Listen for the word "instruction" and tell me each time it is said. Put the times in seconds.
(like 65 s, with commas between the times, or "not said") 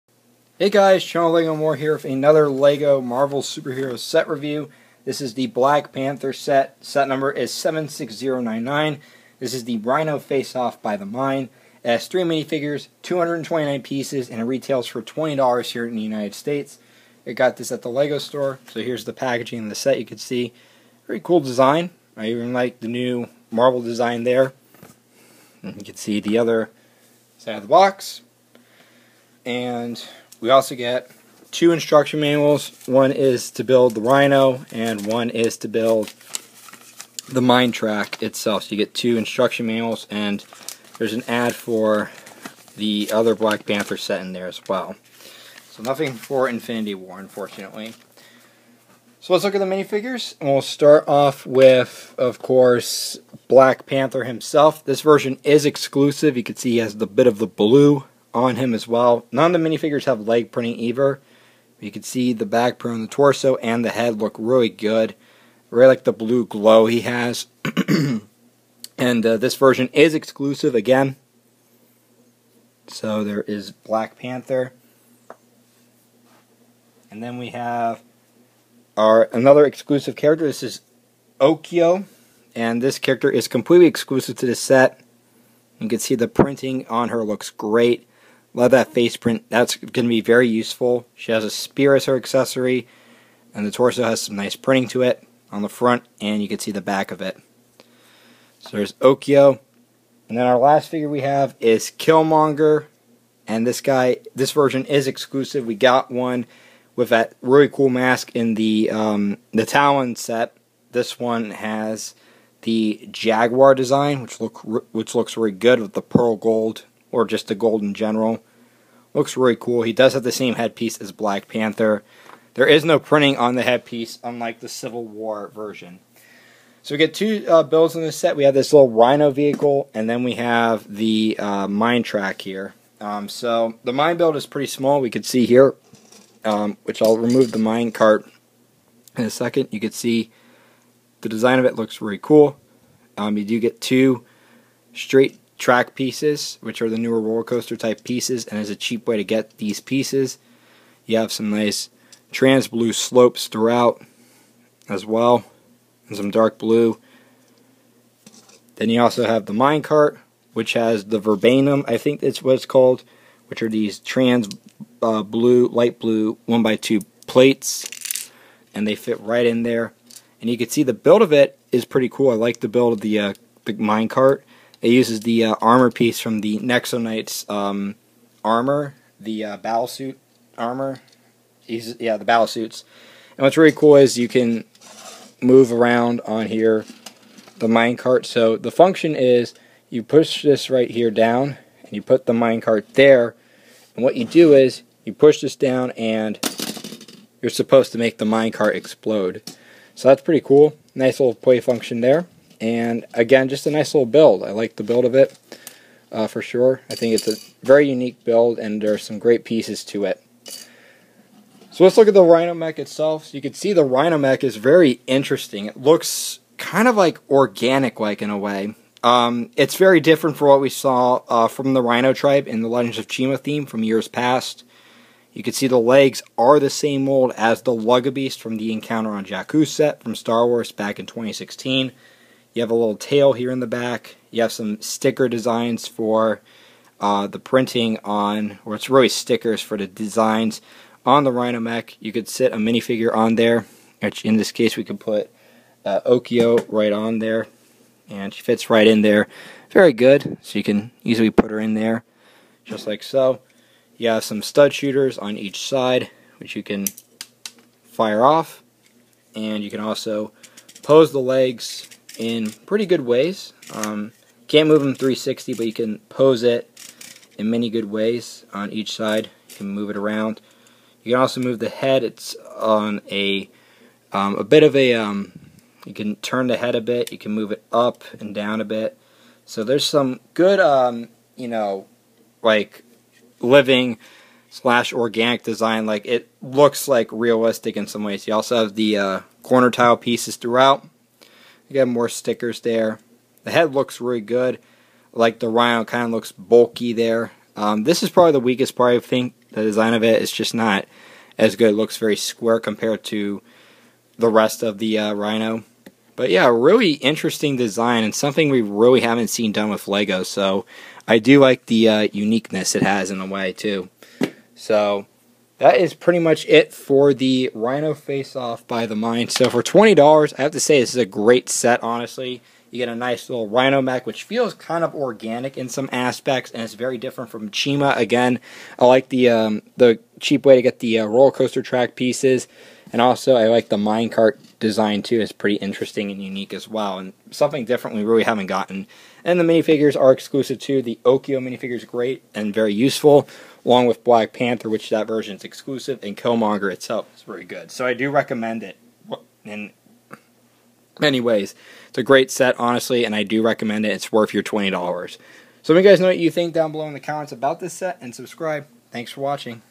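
31 s, 39 s.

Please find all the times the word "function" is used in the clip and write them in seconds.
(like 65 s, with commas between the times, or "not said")
188 s, 201 s.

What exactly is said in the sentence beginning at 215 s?
It looks kind of like organic like in a way.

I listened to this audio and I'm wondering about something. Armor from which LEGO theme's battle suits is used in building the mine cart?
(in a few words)
Nexo Knights.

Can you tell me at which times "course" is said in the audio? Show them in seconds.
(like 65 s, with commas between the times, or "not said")
52 s.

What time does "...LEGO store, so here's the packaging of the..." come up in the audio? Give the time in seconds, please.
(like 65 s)
17 s.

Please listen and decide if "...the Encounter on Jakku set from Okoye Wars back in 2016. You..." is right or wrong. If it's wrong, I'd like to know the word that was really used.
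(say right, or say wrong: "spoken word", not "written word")
wrong: "Star", not "Okoye".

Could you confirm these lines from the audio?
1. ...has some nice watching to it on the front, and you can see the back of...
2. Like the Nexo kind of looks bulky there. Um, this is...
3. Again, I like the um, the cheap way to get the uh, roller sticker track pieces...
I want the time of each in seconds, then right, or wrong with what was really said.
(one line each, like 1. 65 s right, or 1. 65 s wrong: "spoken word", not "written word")
1. 94 s wrong: "printing", not "watching"
2. 295 s wrong: "Rhino", not "Nexo"
3. 327 s wrong: "coaster", not "sticker".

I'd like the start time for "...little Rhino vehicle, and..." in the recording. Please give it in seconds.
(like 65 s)
128 s.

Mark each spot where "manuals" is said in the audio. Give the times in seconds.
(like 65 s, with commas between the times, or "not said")
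32 s, 39 s.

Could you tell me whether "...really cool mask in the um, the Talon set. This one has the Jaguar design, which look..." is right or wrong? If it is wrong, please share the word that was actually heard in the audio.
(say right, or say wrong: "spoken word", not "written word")
right.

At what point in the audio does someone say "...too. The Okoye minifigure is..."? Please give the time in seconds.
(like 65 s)
340 s.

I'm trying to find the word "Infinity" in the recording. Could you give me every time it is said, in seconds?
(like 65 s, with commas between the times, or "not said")
46 s.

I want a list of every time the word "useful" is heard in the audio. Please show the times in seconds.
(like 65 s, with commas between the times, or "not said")
90 s, 342 s.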